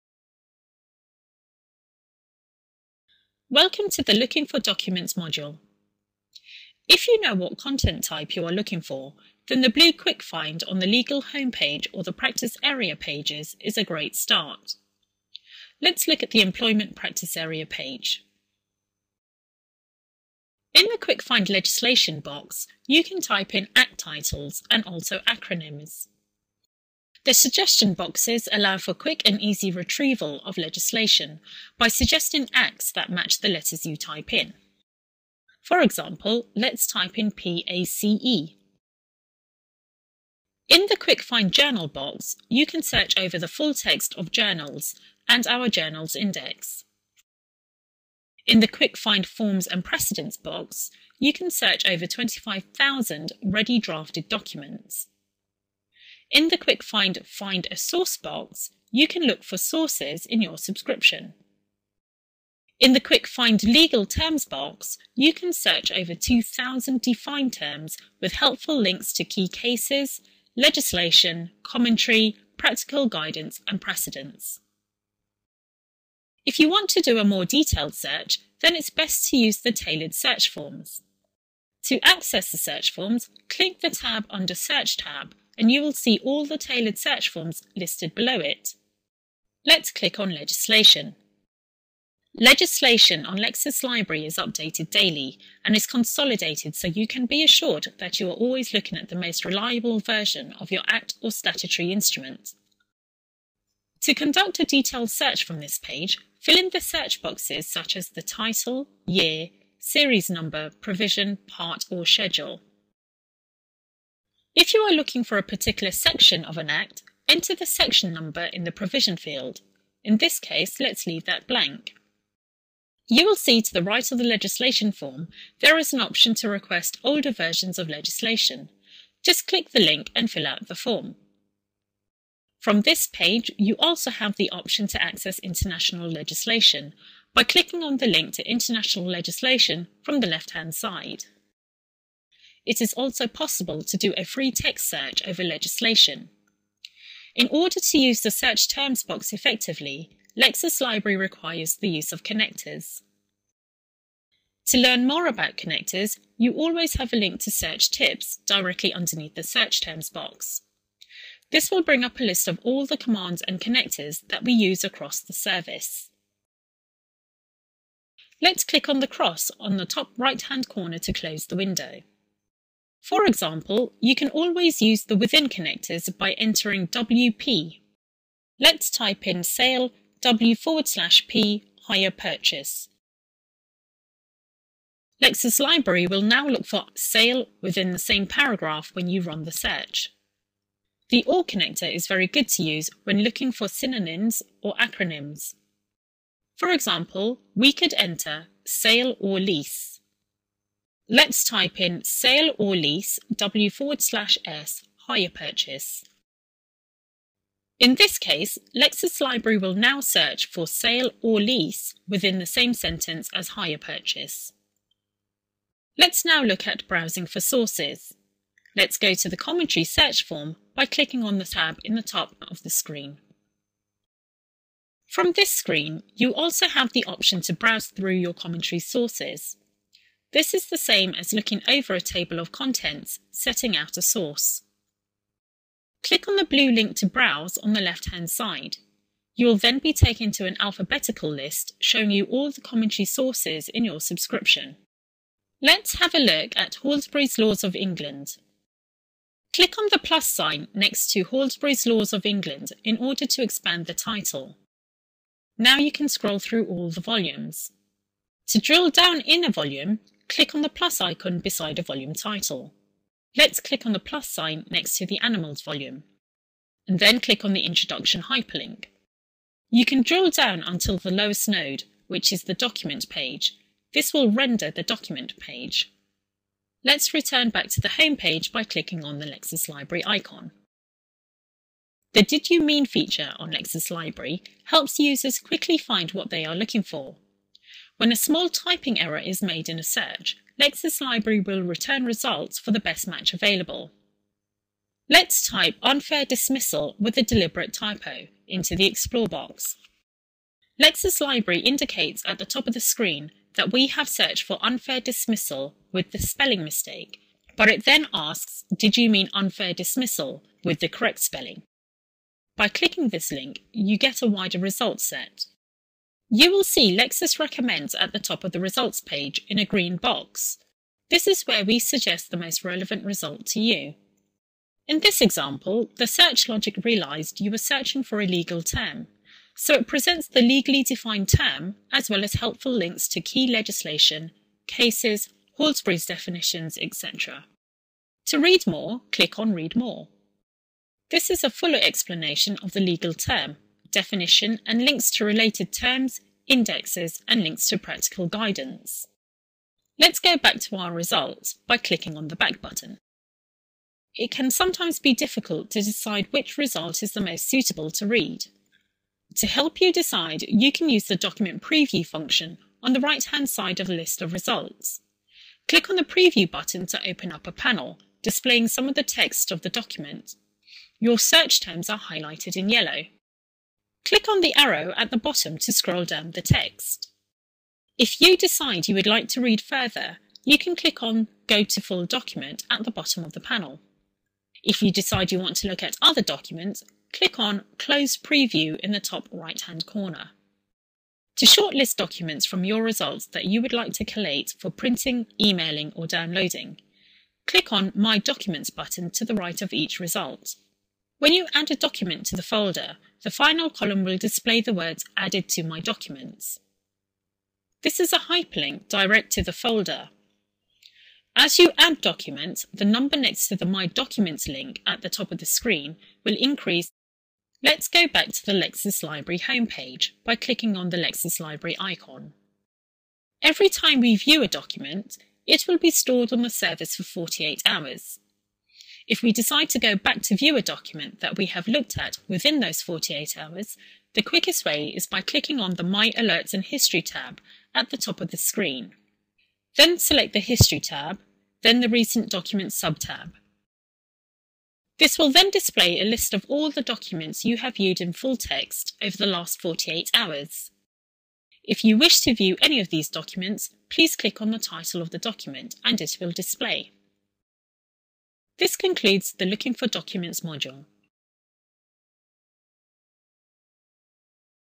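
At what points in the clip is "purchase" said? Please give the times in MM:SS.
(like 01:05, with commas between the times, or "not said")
03:02, 03:25, 03:33.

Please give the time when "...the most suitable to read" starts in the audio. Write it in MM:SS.
05:57.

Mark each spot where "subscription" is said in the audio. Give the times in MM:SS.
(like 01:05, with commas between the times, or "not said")
01:00, 04:03.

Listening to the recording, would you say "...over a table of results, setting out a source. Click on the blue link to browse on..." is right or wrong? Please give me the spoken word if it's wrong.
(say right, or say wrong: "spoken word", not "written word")
wrong: "contents", not "results".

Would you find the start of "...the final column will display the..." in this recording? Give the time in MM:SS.
06:43.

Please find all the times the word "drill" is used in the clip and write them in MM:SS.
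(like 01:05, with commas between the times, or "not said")
04:18, 04:30.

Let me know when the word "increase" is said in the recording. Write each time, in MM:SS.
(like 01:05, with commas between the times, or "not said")
06:56.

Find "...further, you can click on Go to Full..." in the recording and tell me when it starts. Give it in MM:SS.
06:19.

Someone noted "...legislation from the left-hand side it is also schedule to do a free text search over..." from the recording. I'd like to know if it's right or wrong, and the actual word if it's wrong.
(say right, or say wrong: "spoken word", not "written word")
wrong: "possible", not "schedule".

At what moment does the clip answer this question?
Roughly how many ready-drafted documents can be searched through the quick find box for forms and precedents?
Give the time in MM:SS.
00:52.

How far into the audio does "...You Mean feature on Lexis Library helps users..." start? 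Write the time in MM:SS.
04:42.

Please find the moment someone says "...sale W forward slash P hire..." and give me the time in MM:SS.
02:59.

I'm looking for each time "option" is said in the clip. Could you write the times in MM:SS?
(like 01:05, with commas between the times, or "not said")
02:06, 02:14, 03:47.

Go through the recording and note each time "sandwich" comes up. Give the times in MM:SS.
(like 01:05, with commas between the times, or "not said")
not said.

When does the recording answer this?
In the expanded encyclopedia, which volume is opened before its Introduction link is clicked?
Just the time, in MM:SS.
04:25.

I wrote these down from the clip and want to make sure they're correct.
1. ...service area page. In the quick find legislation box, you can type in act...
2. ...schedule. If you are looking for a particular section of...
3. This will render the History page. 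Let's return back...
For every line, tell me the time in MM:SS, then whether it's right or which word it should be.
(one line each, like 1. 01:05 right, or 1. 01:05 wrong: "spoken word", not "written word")
1. 00:16 wrong: "practice", not "service"
2. 01:52 right
3. 04:33 wrong: "Document", not "History".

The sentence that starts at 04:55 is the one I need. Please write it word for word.
Let's type unfair dismissal with a deliberate typo into the Explore box.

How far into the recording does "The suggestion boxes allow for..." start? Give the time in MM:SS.
00:27.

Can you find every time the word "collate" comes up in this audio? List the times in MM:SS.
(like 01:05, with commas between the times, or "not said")
06:34.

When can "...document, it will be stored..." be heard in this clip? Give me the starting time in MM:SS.
07:04.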